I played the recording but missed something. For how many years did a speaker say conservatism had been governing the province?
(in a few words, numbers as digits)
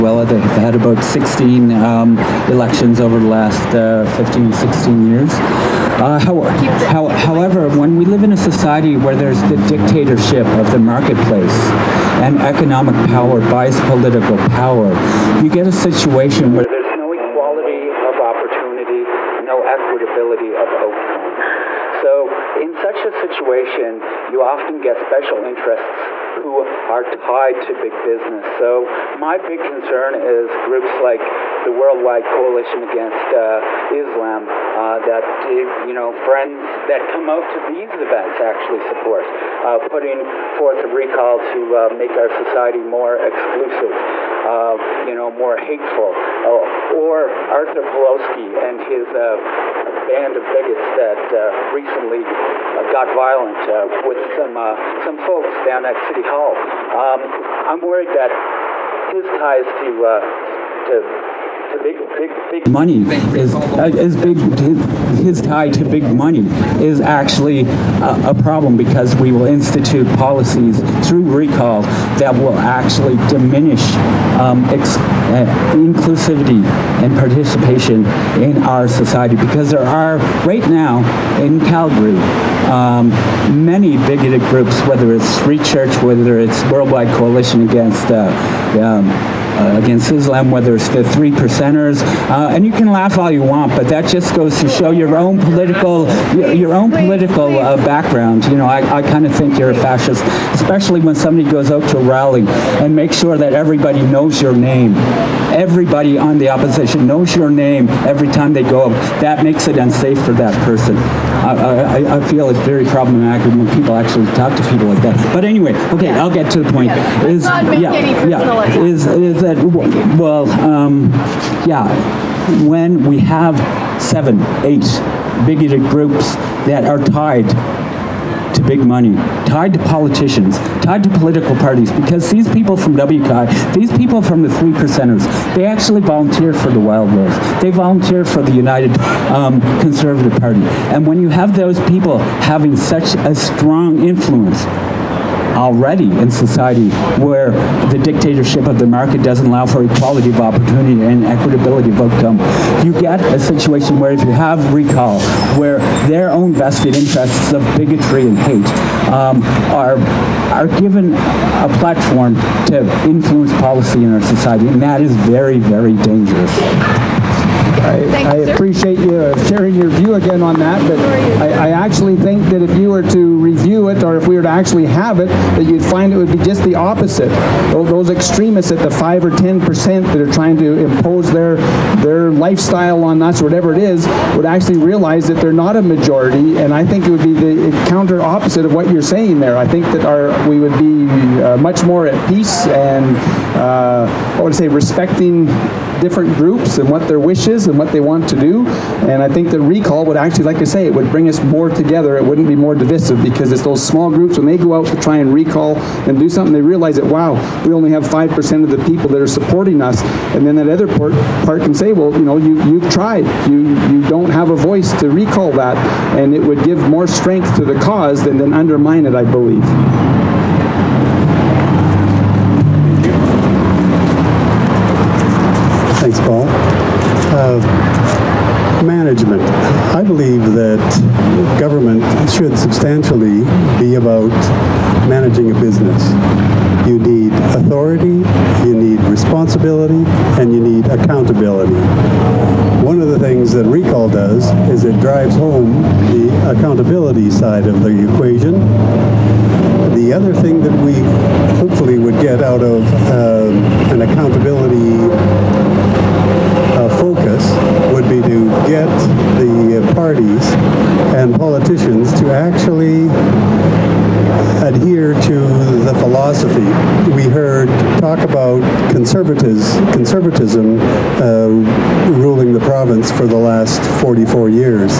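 44.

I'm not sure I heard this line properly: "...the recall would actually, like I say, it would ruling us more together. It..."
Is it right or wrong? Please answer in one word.
wrong.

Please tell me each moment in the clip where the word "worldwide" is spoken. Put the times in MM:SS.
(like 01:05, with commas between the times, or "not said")
00:31, 01:26.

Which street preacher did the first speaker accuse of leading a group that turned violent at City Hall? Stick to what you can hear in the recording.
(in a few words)
Arthur Pawlowski.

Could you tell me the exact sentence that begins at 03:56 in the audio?
You need authority, you need responsibility, and you need accountability.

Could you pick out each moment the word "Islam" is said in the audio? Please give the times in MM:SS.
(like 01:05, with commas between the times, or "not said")
00:33, 01:30.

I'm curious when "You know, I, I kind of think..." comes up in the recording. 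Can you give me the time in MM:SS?
01:38.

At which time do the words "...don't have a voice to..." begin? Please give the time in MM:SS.
03:34.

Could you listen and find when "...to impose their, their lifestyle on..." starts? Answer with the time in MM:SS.
03:00.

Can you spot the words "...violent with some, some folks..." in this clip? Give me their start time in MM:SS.
00:53.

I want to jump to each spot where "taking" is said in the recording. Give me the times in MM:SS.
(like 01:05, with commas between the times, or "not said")
not said.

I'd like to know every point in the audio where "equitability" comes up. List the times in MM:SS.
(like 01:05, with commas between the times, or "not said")
00:19, 02:31.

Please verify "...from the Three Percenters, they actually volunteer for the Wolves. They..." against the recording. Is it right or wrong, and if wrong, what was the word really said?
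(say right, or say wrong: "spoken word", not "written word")
right.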